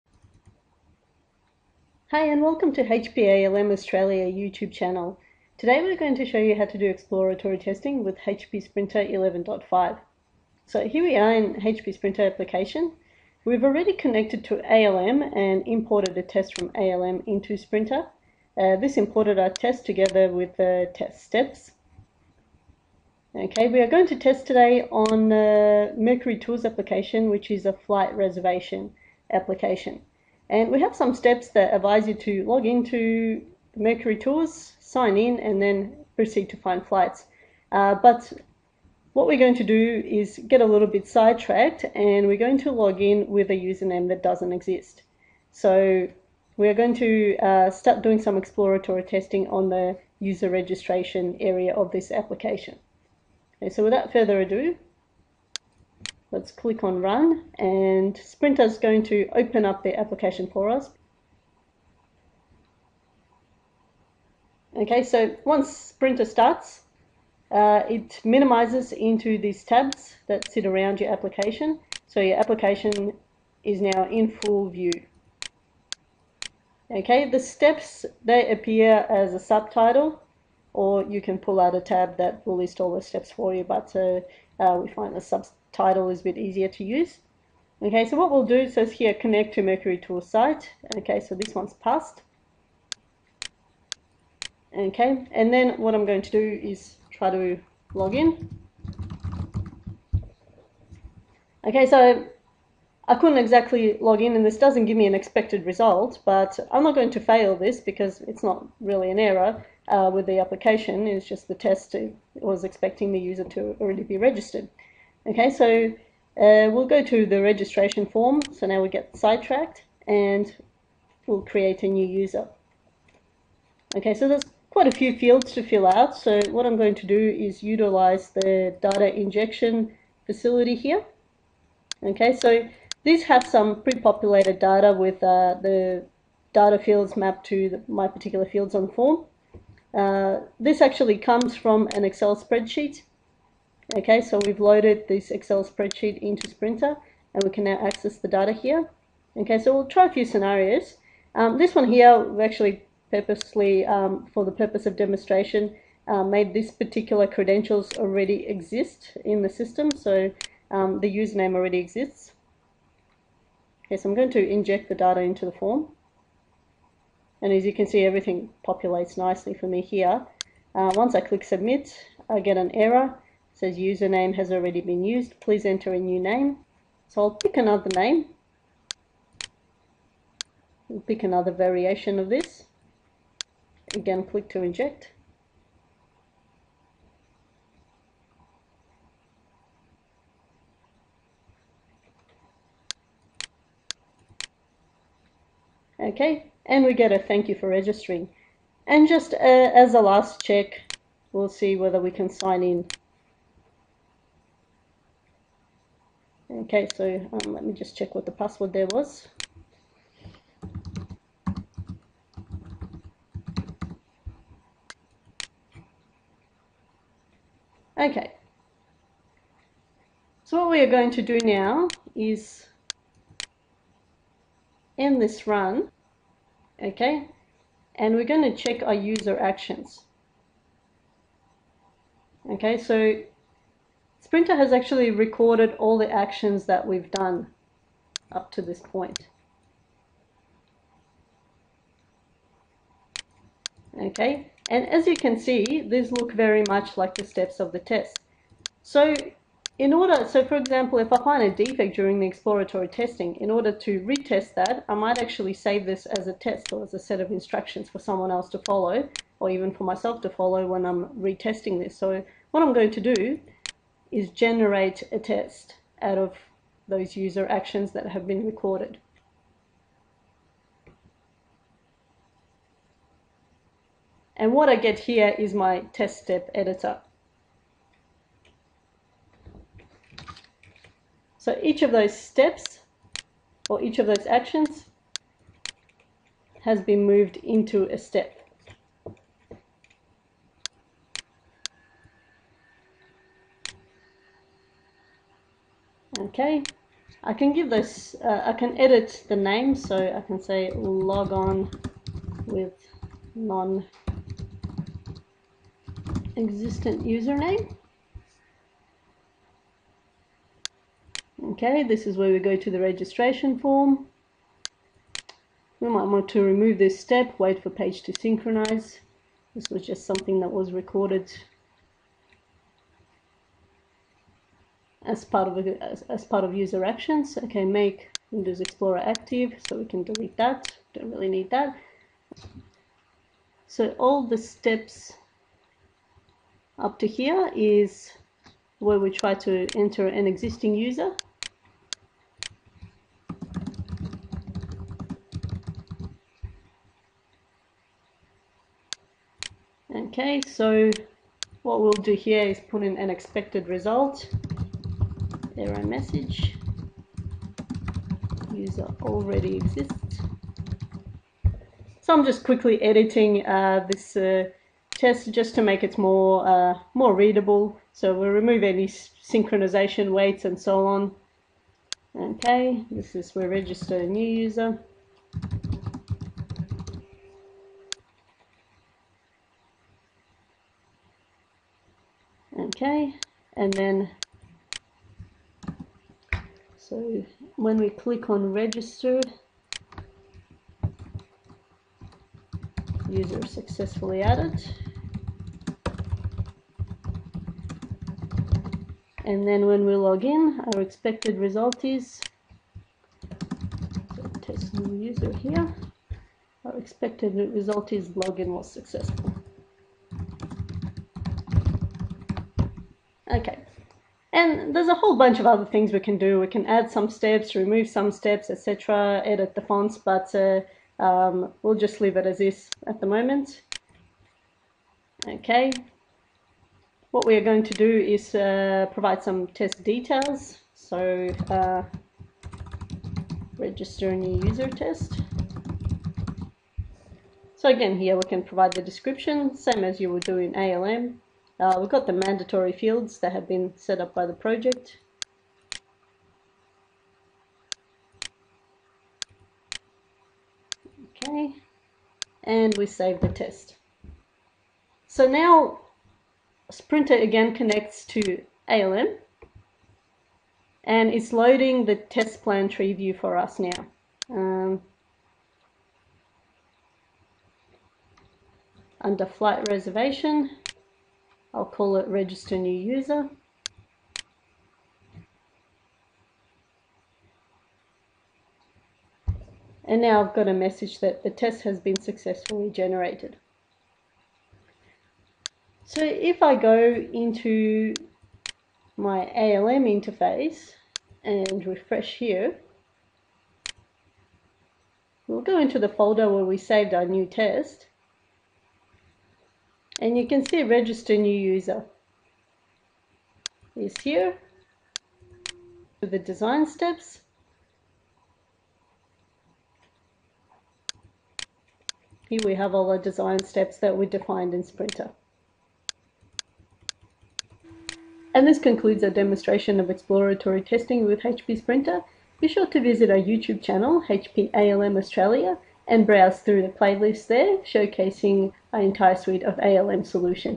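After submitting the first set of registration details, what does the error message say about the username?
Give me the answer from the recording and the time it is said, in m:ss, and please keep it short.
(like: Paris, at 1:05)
has already been used, at 2:54.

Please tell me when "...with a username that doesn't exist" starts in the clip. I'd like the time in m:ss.
0:43.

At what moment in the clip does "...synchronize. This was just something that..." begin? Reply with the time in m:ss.
5:18.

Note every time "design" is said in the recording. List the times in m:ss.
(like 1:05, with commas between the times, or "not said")
8:26, 8:32.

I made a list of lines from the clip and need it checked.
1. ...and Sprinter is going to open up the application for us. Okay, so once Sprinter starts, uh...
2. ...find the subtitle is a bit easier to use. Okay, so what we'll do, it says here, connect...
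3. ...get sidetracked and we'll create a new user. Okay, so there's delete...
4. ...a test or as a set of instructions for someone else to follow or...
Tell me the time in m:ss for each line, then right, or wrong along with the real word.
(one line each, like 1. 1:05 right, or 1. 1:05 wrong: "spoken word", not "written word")
1. 0:57 right
2. 1:24 right
3. 1:58 wrong: "quite", not "delete"
4. 4:16 right.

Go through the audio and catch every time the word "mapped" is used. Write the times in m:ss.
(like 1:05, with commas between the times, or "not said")
2:17.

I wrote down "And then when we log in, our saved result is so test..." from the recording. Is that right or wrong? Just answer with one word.
wrong.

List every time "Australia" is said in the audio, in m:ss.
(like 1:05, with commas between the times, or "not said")
0:03, 8:44.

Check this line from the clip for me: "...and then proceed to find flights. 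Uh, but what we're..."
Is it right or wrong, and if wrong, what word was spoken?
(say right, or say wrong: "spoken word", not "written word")
right.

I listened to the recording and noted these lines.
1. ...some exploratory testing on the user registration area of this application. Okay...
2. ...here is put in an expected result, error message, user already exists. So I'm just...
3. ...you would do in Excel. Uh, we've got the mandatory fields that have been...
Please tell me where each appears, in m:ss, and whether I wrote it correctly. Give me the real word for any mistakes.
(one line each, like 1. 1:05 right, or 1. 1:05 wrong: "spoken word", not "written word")
1. 0:48 right
2. 5:52 right
3. 7:19 wrong: "ALM", not "Excel".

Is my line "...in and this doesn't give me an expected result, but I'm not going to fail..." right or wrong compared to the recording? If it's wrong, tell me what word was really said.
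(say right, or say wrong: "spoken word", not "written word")
right.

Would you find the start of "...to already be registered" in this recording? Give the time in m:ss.
1:53.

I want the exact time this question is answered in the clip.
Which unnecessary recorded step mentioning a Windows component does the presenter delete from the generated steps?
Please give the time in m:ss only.
5:27.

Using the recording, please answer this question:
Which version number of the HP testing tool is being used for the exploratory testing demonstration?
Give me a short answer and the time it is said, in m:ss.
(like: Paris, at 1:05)
11.5, at 0:09.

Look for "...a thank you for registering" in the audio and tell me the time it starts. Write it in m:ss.
3:17.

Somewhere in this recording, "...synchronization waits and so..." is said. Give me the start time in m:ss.
6:08.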